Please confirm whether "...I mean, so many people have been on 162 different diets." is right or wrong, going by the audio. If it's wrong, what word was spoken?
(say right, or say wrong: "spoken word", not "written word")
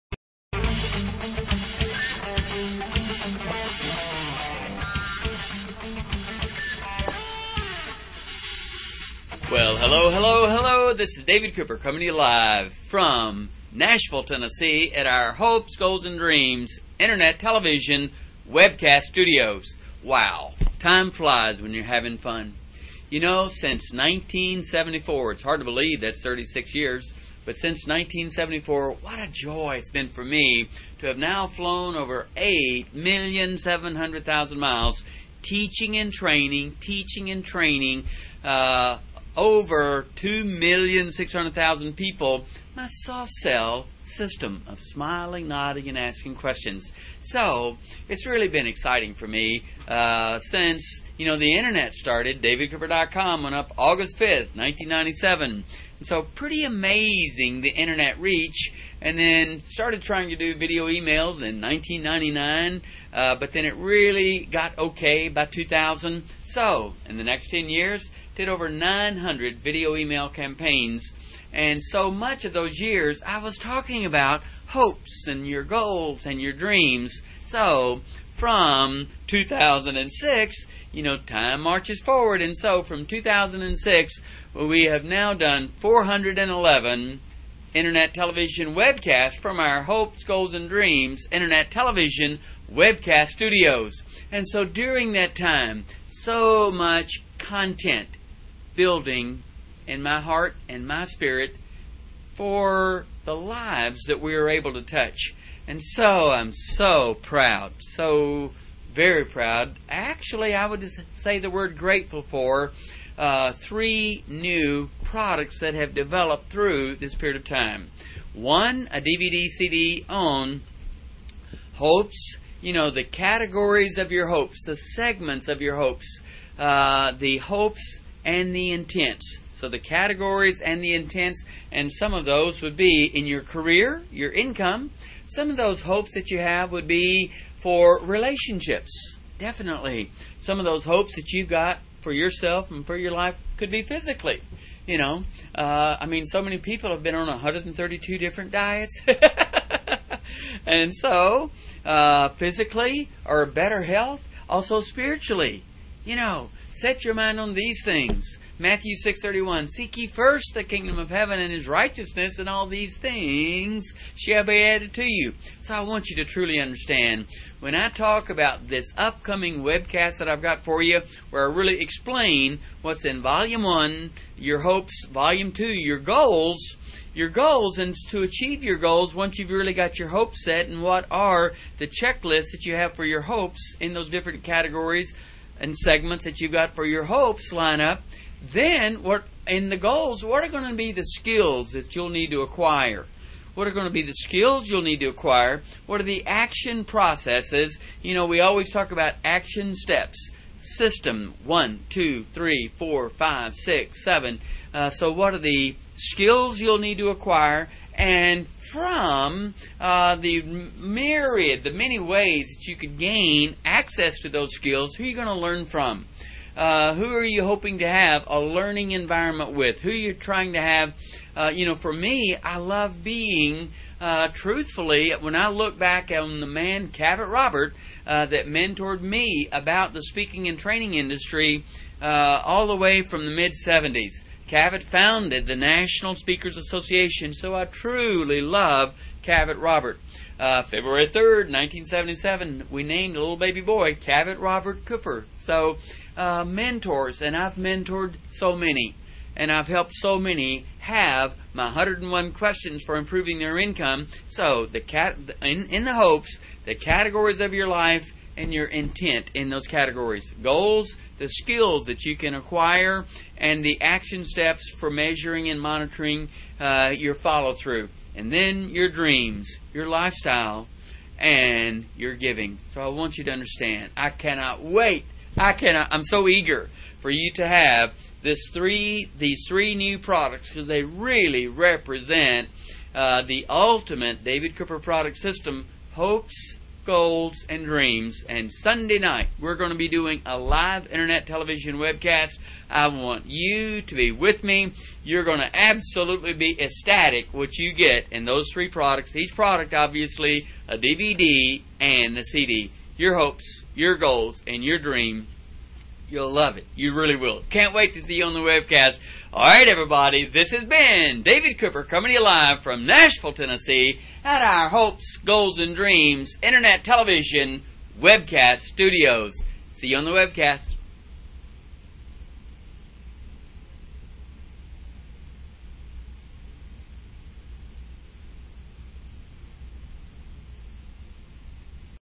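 wrong: "132", not "162".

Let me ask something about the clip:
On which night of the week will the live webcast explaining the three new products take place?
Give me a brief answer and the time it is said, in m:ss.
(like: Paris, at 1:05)
Sunday night, at 4:48.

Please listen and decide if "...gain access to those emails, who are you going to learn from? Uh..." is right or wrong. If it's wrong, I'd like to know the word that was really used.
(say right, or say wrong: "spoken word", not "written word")
wrong: "skills", not "emails".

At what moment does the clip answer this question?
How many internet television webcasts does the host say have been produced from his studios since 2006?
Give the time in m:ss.
1:25.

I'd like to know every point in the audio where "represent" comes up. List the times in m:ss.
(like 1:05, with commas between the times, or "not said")
4:41.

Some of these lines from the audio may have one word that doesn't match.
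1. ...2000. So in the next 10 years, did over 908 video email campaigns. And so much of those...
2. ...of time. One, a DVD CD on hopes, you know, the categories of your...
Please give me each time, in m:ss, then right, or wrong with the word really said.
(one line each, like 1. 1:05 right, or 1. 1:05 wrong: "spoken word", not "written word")
1. 1:05 wrong: "900", not "908"
2. 1:57 right.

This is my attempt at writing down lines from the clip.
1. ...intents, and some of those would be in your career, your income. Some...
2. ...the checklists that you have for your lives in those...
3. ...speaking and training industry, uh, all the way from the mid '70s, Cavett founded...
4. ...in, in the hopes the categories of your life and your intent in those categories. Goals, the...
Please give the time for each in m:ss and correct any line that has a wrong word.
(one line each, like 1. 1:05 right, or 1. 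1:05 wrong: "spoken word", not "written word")
1. 2:10 right
2. 3:01 wrong: "hopes", not "lives"
3. 3:50 right
4. 4:15 right.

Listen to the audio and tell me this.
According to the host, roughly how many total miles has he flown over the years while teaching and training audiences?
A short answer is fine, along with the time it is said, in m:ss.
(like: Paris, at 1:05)
8,700,000 miles, at 0:32.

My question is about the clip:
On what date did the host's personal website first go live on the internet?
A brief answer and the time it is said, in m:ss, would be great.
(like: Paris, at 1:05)
August 5th, 1997, at 0:53.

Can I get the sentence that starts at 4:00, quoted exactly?
Uh, February 3rd, 1977, we named a little baby boy Cavett Robert Cooper.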